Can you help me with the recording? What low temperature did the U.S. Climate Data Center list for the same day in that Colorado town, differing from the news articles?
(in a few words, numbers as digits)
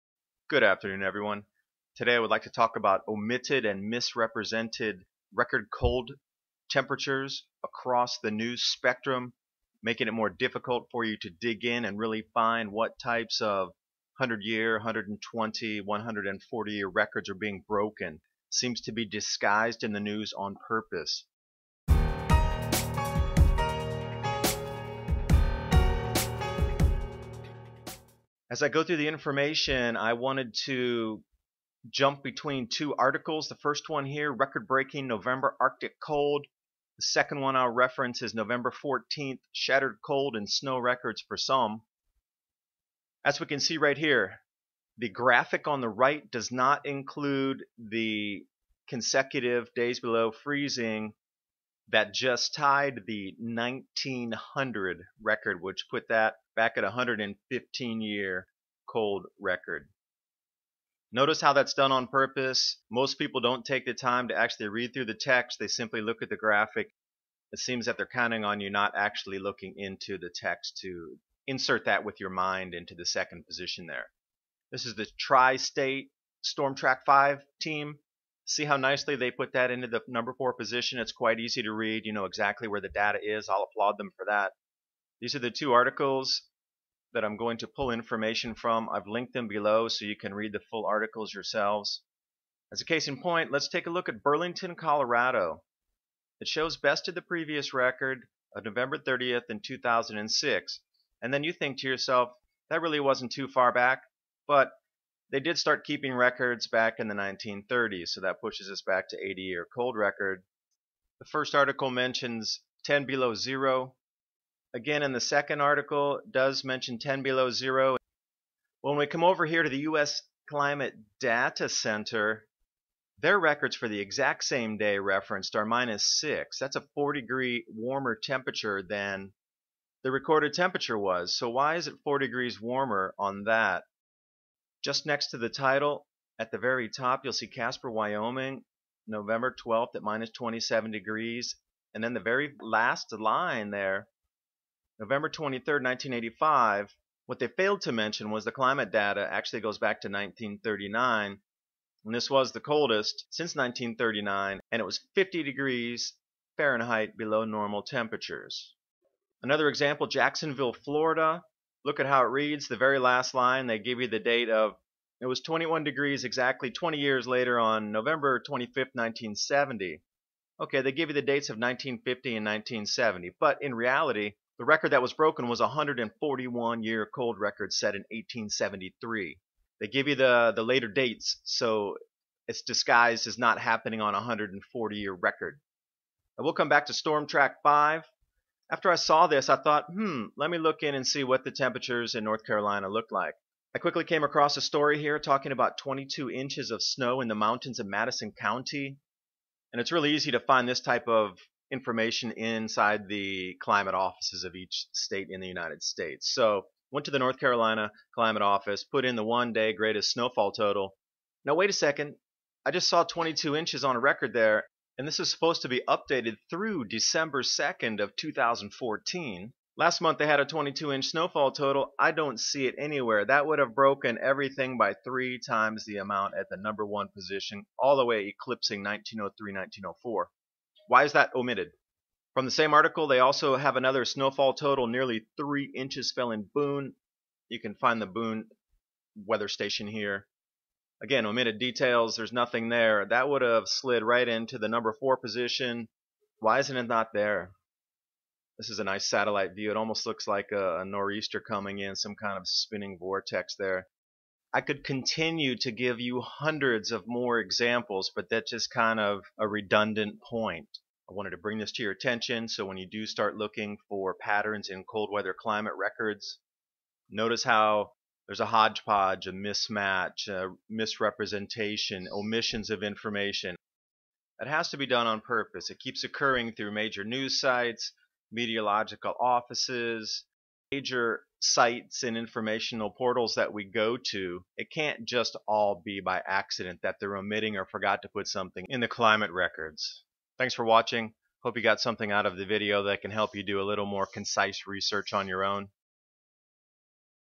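-6.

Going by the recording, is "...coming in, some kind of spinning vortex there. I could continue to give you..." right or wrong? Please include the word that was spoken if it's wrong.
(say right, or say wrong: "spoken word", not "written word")
right.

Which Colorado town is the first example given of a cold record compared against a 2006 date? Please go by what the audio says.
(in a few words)
Burlington.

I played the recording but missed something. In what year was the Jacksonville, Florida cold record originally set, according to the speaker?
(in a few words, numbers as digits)
1873.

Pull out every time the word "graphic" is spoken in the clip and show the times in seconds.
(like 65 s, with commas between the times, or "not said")
45 s, 66 s.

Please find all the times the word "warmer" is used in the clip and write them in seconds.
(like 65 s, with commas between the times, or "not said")
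127 s, 132 s.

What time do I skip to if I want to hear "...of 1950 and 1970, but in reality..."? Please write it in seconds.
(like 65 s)
171 s.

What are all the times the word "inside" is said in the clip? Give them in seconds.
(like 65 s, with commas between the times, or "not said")
202 s.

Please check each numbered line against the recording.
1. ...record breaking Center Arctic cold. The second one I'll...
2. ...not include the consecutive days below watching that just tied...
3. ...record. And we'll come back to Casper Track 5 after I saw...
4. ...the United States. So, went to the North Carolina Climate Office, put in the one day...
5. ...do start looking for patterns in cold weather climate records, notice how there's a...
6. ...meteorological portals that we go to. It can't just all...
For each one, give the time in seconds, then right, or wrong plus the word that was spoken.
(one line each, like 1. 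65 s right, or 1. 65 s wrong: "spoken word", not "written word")
1. 34 s wrong: "November", not "Center"
2. 46 s wrong: "freezing", not "watching"
3. 185 s wrong: "Storm", not "Casper"
4. 205 s right
5. 262 s right
6. 282 s wrong: "informational", not "meteorological".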